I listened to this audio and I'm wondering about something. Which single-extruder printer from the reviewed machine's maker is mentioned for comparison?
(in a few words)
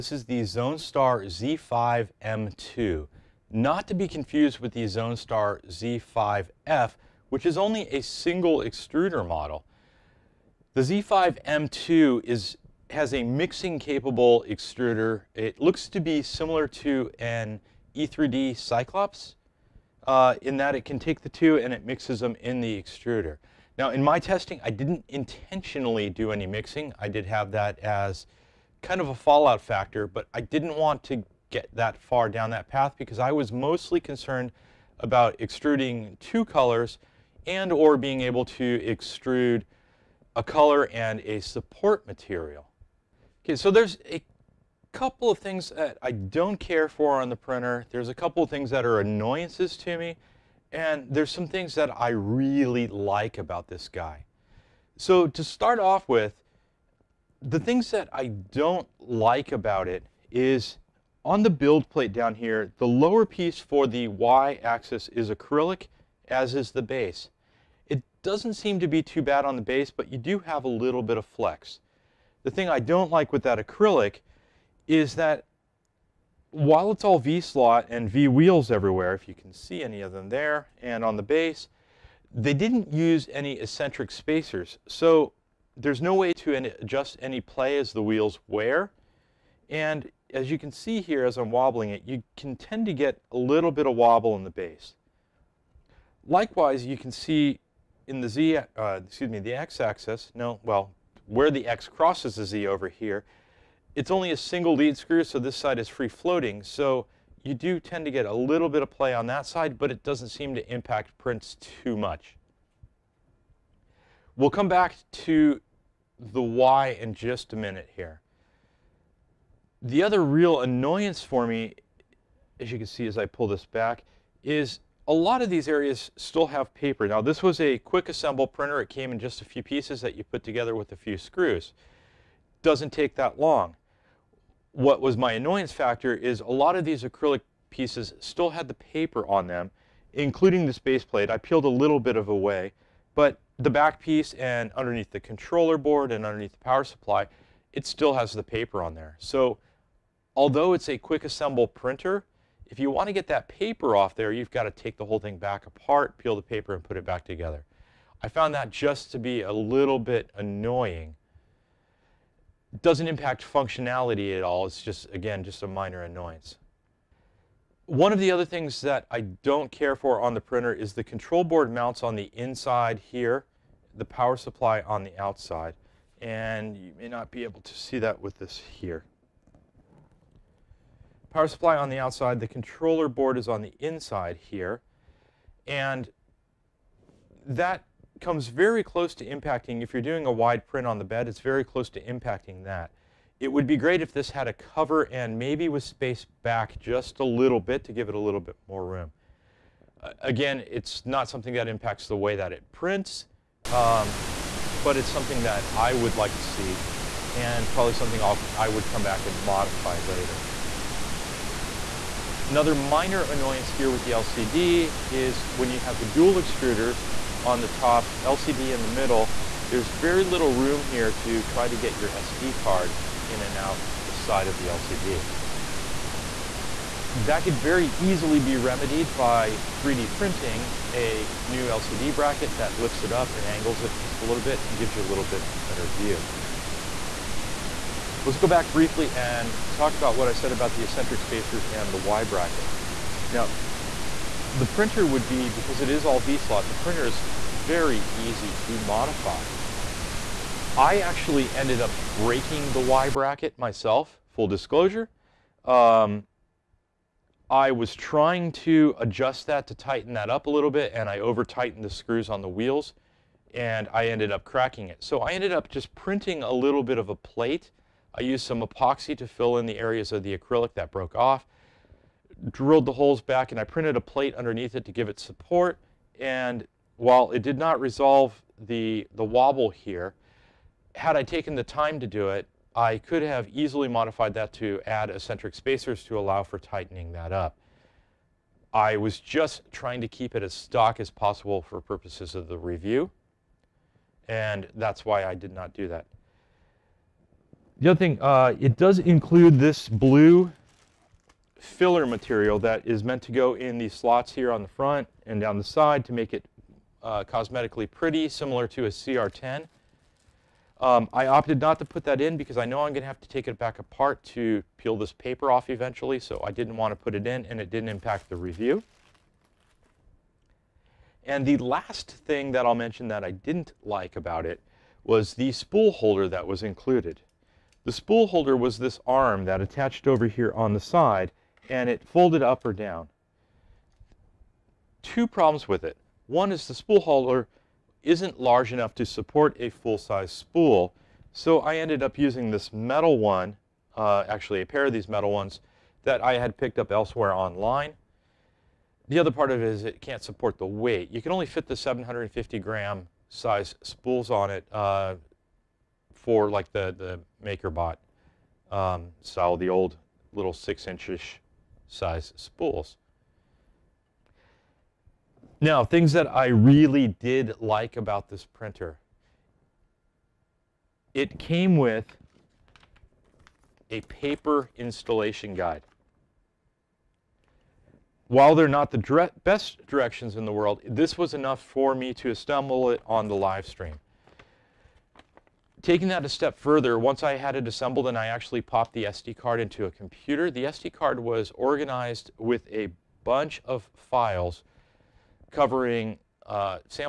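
Zone Star Z5F.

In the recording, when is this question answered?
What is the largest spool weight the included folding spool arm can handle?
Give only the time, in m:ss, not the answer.
5:51.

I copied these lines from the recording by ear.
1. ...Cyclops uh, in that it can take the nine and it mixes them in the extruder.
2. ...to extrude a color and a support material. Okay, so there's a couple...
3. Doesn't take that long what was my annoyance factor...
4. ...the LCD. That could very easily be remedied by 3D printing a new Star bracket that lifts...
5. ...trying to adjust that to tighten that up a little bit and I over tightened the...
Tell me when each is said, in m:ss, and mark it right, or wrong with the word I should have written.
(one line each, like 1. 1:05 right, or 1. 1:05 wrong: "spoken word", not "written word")
1. 0:18 wrong: "two", not "nine"
2. 0:38 right
3. 2:12 right
4. 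3:44 wrong: "LCD", not "Star"
5. 4:17 right.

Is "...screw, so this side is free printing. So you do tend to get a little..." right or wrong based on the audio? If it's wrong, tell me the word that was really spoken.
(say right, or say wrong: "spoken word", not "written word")
wrong: "floating", not "printing".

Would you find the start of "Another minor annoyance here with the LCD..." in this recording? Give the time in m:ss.
3:32.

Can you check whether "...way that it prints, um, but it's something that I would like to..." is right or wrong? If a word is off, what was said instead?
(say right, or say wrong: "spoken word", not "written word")
right.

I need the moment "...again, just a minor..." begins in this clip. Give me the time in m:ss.
2:45.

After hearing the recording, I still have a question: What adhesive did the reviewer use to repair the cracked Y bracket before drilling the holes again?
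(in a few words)
Epoxy.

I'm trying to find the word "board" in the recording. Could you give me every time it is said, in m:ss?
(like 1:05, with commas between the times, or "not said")
2:25, 2:51, 3:03.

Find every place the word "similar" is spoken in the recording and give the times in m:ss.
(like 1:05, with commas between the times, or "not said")
0:16, 5:08.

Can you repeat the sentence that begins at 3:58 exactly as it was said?
Let's go back briefly and talk about what I said about the eccentric spacers and the Y bracket.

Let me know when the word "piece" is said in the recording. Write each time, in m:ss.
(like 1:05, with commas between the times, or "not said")
1:03, 2:09, 2:17, 2:23.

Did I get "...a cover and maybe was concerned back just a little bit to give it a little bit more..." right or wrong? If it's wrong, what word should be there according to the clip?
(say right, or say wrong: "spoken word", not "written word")
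wrong: "spaced", not "concerned".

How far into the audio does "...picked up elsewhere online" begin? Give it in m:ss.
5:46.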